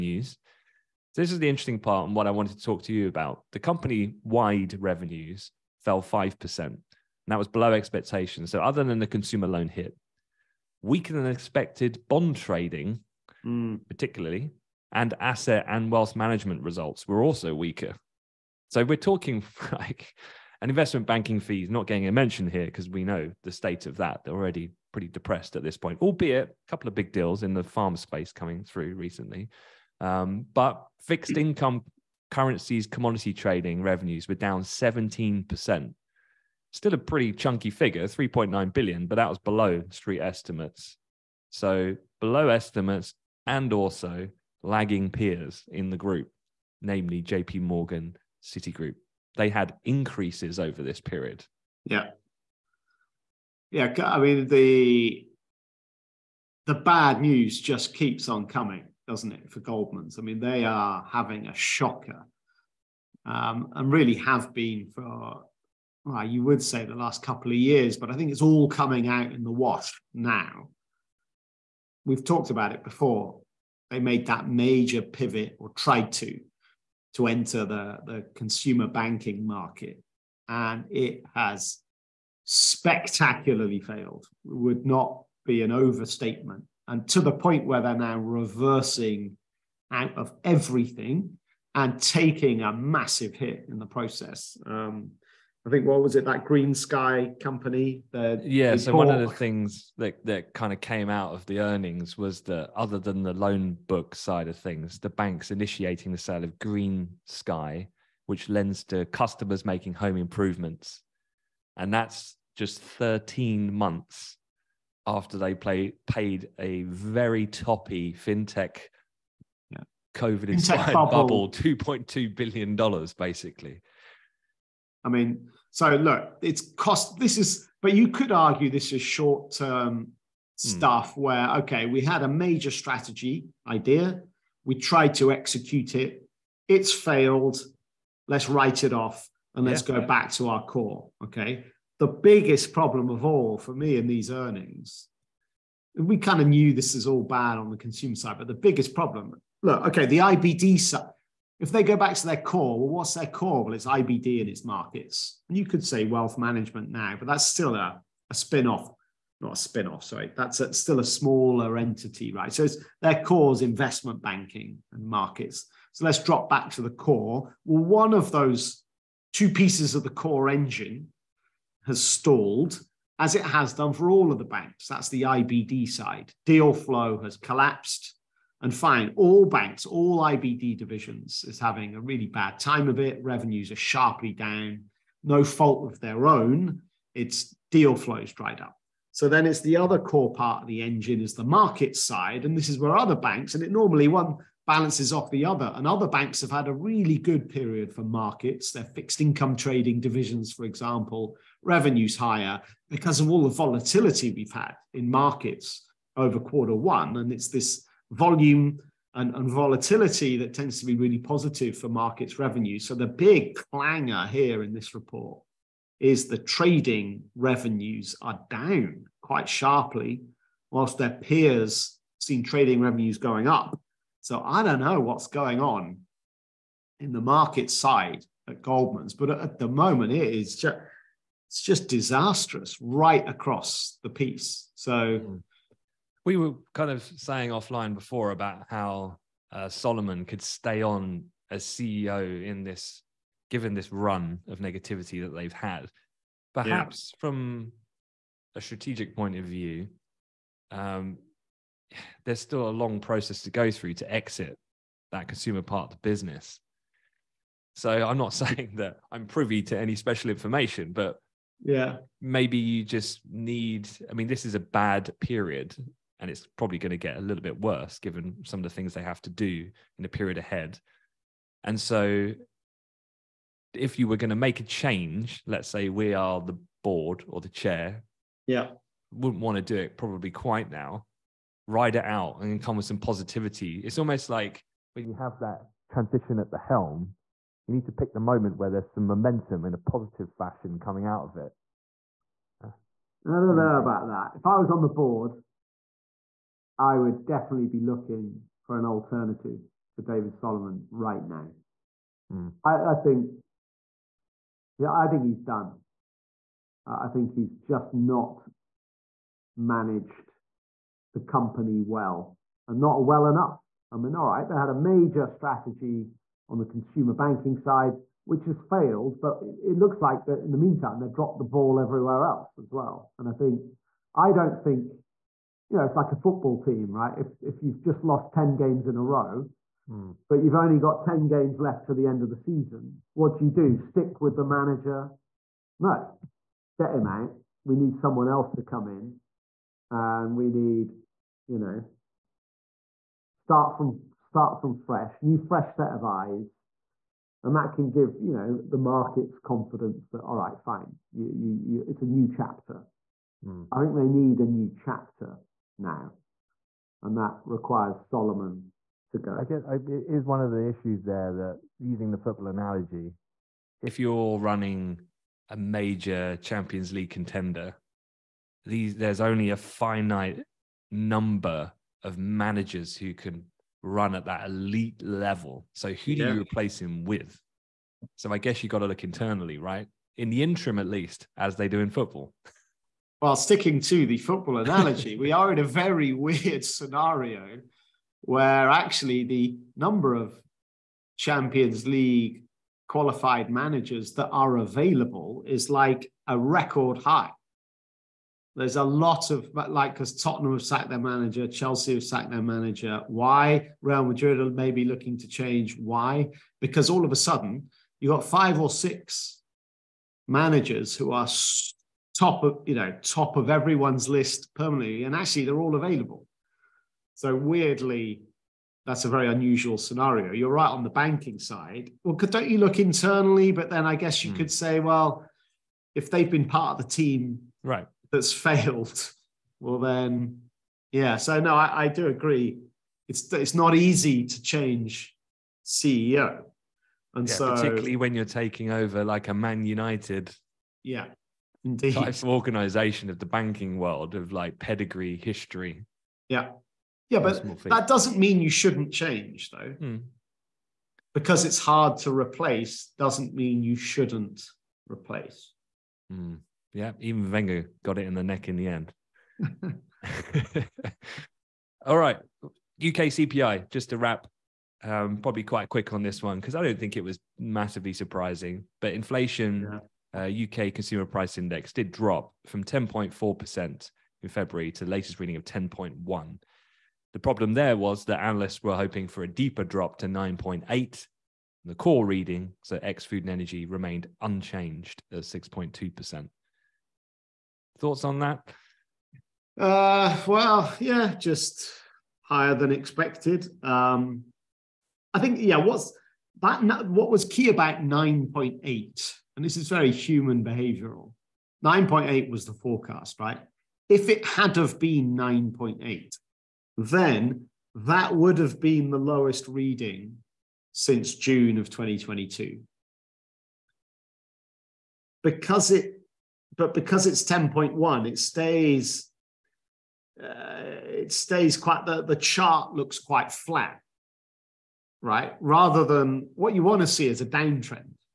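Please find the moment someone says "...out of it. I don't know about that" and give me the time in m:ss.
4:51.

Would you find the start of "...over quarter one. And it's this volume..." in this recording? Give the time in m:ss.
3:26.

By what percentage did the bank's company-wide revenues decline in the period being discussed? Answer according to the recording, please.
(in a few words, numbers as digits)
5%.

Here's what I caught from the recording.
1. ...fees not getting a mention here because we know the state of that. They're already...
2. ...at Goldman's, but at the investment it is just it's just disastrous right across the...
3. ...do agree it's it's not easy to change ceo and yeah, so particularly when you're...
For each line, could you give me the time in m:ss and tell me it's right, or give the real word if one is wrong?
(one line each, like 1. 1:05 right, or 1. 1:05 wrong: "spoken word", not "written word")
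1. 0:21 right
2. 3:48 wrong: "moment", not "investment"
3. 7:11 right.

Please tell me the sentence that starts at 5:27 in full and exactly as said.
If if you've just lost 10 games in a row, mm.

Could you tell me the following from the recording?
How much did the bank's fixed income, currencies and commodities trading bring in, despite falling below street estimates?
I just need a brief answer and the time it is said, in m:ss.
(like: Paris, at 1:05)
3.9 billion, at 0:38.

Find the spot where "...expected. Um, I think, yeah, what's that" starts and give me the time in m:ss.
8:12.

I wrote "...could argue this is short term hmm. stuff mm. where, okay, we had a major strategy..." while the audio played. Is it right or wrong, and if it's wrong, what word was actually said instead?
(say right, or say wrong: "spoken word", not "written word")
right.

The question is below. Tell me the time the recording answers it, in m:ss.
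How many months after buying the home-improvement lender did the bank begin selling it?
1:52.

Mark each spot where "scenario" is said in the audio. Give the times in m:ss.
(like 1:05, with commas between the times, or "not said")
6:26, 6:59.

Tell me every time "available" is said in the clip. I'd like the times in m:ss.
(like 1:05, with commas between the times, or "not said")
6:34, 6:55.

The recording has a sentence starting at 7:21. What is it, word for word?
Type of organization of the banking world of like pedigree, history.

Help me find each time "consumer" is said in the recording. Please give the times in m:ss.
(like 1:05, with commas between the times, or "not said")
0:09, 1:18, 2:27, 4:15, 5:16, 7:50.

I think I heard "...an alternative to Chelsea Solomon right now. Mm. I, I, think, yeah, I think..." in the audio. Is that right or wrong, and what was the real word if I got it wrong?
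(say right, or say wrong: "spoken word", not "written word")
wrong: "David", not "Chelsea".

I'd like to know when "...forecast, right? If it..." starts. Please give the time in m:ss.
8:22.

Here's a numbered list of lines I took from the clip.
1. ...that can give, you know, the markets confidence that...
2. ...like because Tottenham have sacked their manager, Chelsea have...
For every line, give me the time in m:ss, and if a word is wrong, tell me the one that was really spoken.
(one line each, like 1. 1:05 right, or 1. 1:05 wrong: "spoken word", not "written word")
1. 5:47 right
2. 6:39 right.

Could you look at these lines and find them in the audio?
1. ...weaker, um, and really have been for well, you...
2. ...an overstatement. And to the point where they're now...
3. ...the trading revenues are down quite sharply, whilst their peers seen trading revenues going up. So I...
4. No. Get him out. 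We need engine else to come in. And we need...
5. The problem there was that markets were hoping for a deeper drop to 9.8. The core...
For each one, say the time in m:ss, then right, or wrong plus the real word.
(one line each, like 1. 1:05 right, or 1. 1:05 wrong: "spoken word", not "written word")
1. 1:01 wrong: "shocker", not "weaker"
2. 1:25 right
3. 3:36 right
4. 5:35 wrong: "someone", not "engine"
5. 7:57 wrong: "analysts", not "markets".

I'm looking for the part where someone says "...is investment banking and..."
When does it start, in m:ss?
2:43.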